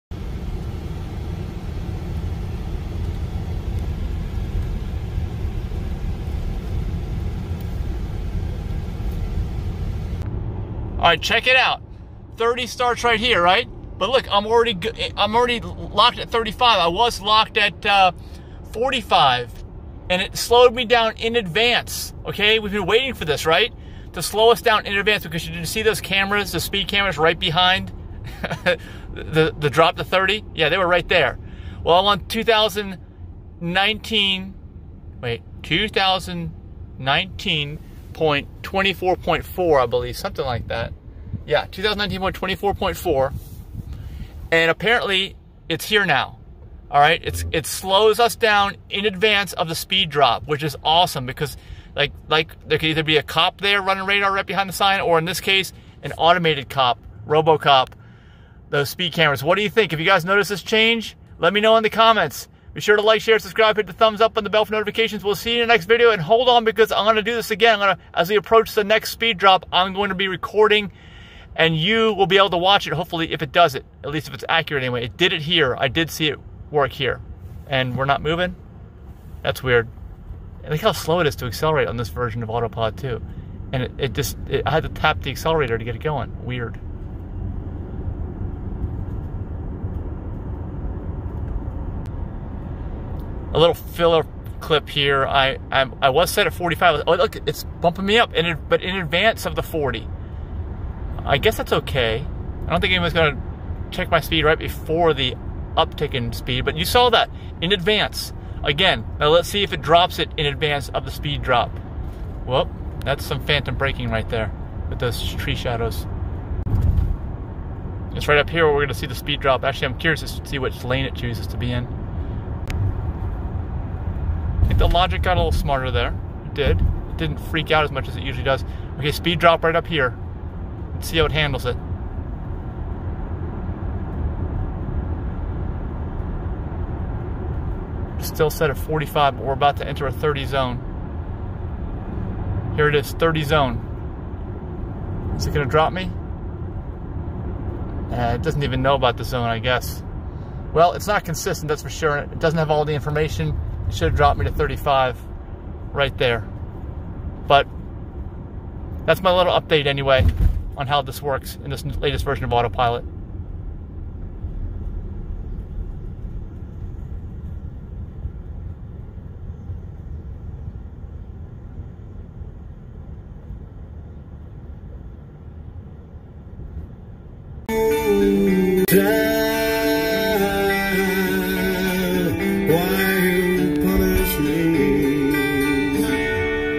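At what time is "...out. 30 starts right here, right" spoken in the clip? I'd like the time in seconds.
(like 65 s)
11 s.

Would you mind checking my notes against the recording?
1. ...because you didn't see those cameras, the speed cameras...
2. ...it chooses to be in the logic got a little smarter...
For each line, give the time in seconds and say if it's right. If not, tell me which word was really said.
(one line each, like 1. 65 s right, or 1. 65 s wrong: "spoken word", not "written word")
1. 25 s right
2. 121 s right.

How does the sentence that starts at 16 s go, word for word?
I was locked at uh, 45, and it slowed me down in advance.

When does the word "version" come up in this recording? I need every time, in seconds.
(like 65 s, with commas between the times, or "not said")
82 s, 162 s.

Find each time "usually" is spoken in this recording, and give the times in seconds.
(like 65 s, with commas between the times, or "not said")
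128 s.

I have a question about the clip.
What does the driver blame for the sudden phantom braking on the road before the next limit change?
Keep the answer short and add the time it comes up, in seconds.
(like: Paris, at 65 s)
tree shadows, at 115 s.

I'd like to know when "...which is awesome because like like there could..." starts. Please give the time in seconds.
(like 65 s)
50 s.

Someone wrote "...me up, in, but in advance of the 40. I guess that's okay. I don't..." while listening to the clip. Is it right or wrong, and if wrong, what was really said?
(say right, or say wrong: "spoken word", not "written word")
right.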